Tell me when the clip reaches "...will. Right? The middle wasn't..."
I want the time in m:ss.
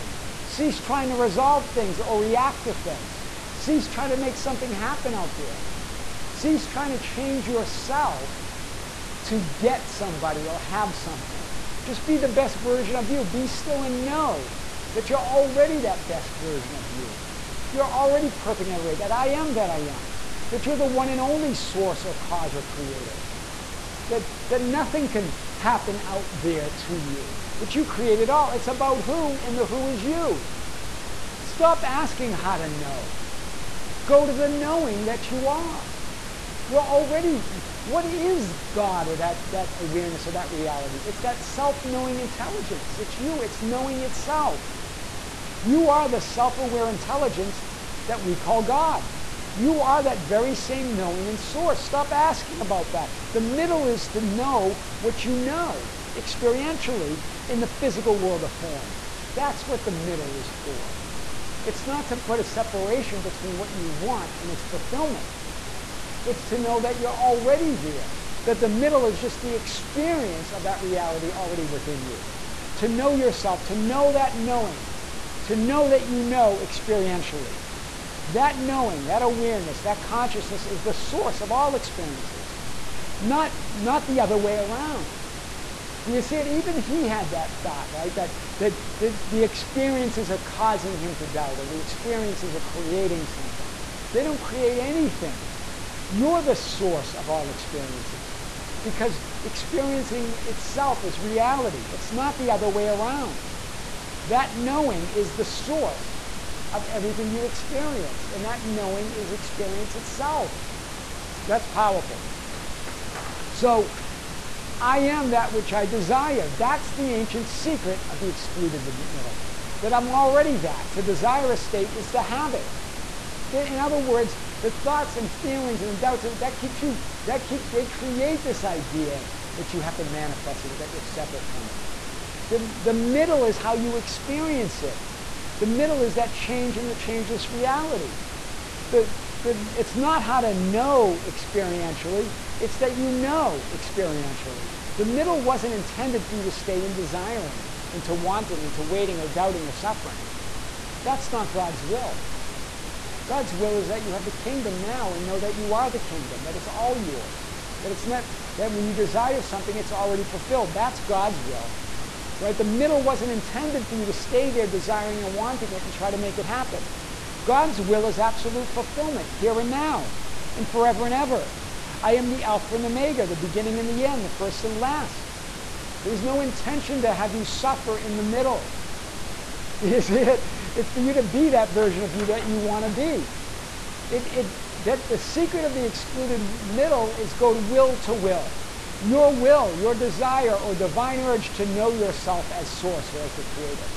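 2:41.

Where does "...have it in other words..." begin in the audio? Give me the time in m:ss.
2:02.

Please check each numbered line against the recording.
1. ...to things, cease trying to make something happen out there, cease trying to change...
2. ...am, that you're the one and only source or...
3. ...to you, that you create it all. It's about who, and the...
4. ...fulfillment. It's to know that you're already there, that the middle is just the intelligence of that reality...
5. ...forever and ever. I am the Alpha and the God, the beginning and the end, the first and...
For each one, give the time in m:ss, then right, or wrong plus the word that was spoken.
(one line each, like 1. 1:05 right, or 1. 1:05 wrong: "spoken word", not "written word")
1. 0:02 right
2. 0:19 right
3. 0:26 right
4. 1:04 wrong: "experience", not "intelligence"
5. 2:50 wrong: "Omega", not "God".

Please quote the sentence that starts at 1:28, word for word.
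That, that, that the experiences are causing him to doubt, or the experiences are creating something.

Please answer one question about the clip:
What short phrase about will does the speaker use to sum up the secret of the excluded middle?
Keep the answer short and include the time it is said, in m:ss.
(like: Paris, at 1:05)
Go will to will, at 3:07.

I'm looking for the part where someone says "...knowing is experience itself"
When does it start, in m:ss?
1:48.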